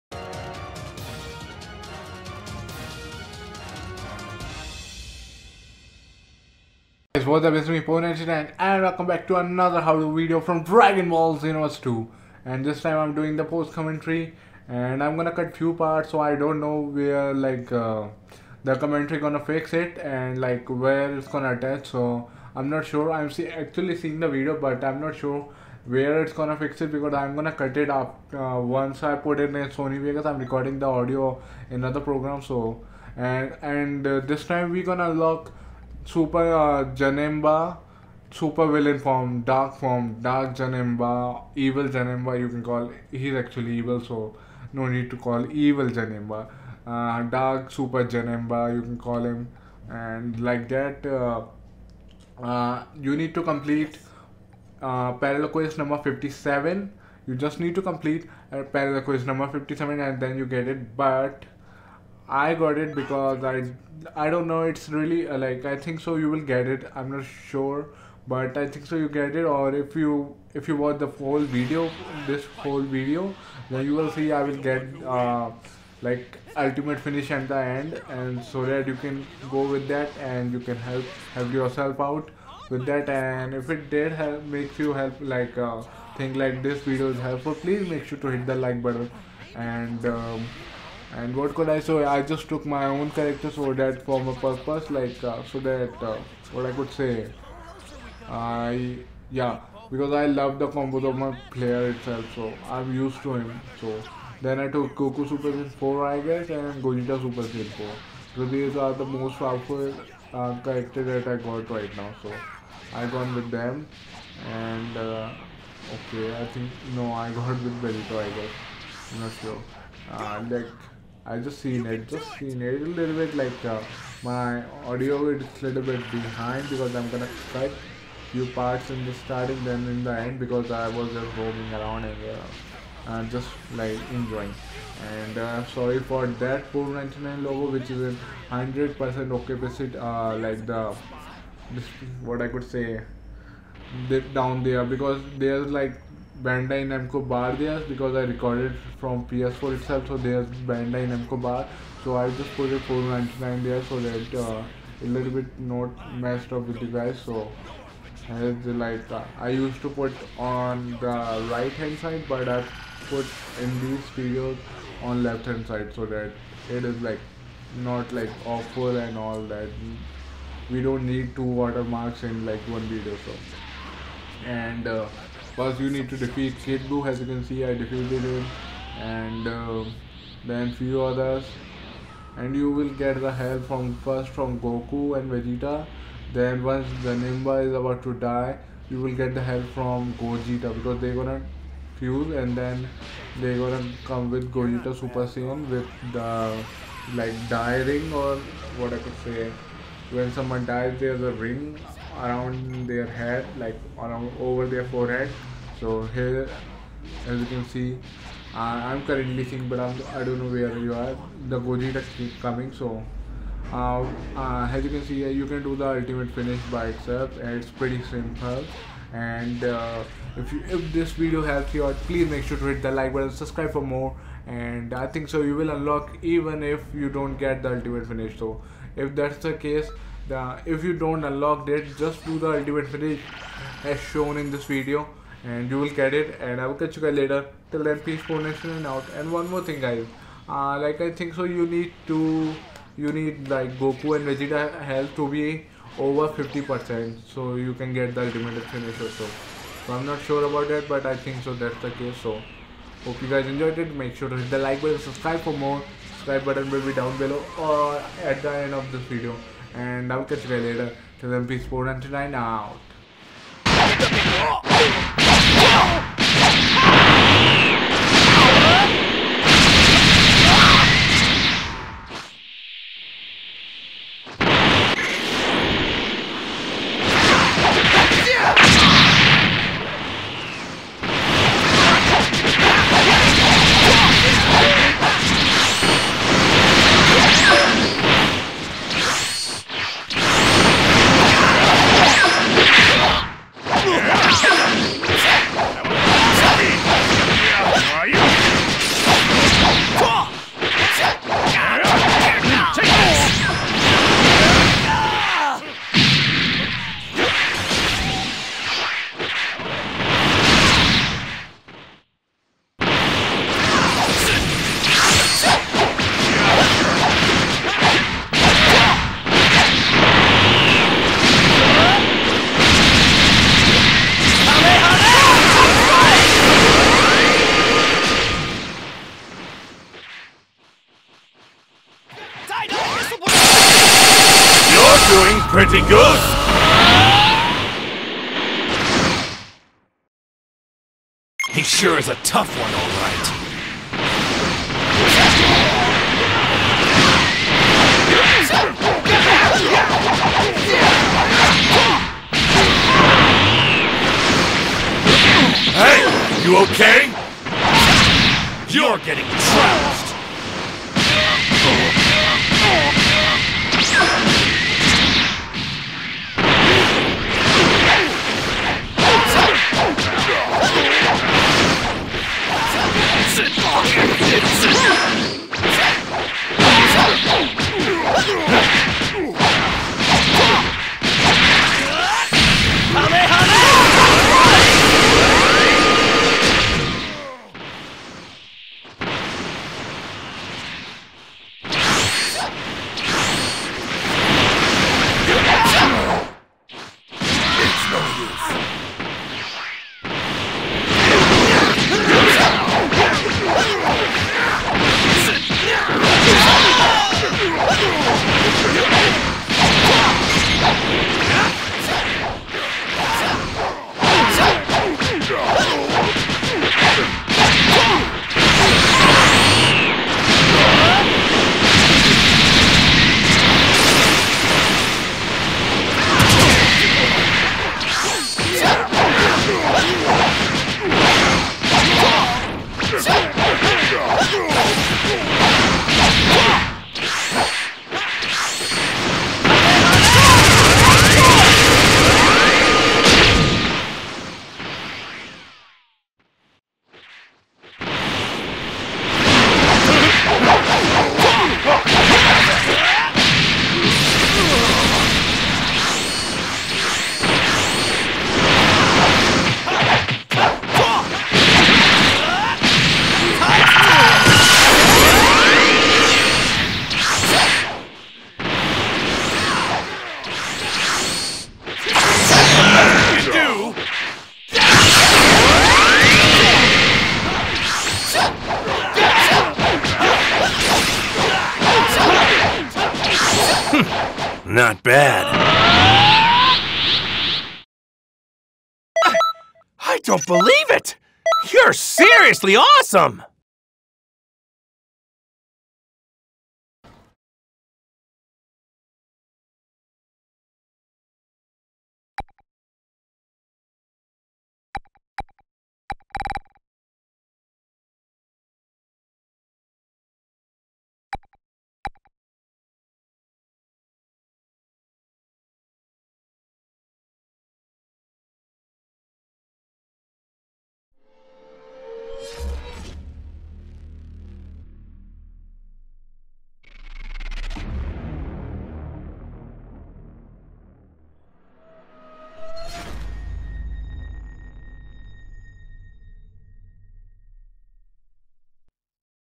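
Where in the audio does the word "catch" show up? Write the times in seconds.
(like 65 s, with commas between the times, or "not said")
236 s, 260 s.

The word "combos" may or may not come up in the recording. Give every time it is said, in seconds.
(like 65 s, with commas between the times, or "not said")
100 s.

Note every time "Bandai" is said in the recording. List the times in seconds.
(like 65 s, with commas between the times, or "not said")
146 s, 150 s.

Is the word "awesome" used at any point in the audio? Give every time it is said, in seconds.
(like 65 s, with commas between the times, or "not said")
492 s.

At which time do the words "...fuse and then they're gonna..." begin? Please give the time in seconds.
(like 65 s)
191 s.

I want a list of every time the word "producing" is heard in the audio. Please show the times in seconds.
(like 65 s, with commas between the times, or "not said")
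not said.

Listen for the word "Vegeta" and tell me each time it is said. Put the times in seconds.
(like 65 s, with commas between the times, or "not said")
185 s, 244 s.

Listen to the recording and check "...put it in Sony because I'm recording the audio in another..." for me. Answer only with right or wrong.
right.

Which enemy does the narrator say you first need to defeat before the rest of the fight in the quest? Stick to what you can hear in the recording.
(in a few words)
Kid Buu.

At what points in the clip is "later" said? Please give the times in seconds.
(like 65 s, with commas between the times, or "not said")
237 s, 260 s.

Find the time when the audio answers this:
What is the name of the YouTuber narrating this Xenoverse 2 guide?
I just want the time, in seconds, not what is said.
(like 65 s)
7 s.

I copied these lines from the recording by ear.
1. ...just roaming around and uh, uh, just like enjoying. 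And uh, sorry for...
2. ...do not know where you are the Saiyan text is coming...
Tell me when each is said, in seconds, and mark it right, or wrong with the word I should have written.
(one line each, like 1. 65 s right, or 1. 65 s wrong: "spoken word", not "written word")
1. 131 s right
2. 210 s wrong: "Goji", not "Saiyan".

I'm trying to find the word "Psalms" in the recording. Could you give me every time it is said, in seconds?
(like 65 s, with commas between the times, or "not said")
not said.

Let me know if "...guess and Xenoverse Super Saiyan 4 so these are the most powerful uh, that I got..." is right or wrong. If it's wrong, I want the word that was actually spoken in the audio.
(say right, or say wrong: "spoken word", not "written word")
wrong: "Gogeta", not "Xenoverse".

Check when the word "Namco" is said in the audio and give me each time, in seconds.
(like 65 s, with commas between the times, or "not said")
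146 s, 151 s.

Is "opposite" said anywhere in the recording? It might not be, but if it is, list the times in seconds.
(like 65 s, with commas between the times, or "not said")
139 s.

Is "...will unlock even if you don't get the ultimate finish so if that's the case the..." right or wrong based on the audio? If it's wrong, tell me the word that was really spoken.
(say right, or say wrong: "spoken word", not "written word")
right.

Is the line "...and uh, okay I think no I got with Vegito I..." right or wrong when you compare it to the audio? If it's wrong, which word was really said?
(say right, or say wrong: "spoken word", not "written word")
right.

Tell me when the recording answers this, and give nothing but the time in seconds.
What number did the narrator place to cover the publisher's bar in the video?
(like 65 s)
152 s.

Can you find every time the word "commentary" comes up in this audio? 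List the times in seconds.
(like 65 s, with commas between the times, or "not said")
13 s, 18 s.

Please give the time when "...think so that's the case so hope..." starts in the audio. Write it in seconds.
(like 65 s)
251 s.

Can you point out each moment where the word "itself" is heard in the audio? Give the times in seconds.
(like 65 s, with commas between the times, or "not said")
101 s, 149 s, 216 s.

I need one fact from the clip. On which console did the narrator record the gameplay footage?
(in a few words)
PS4.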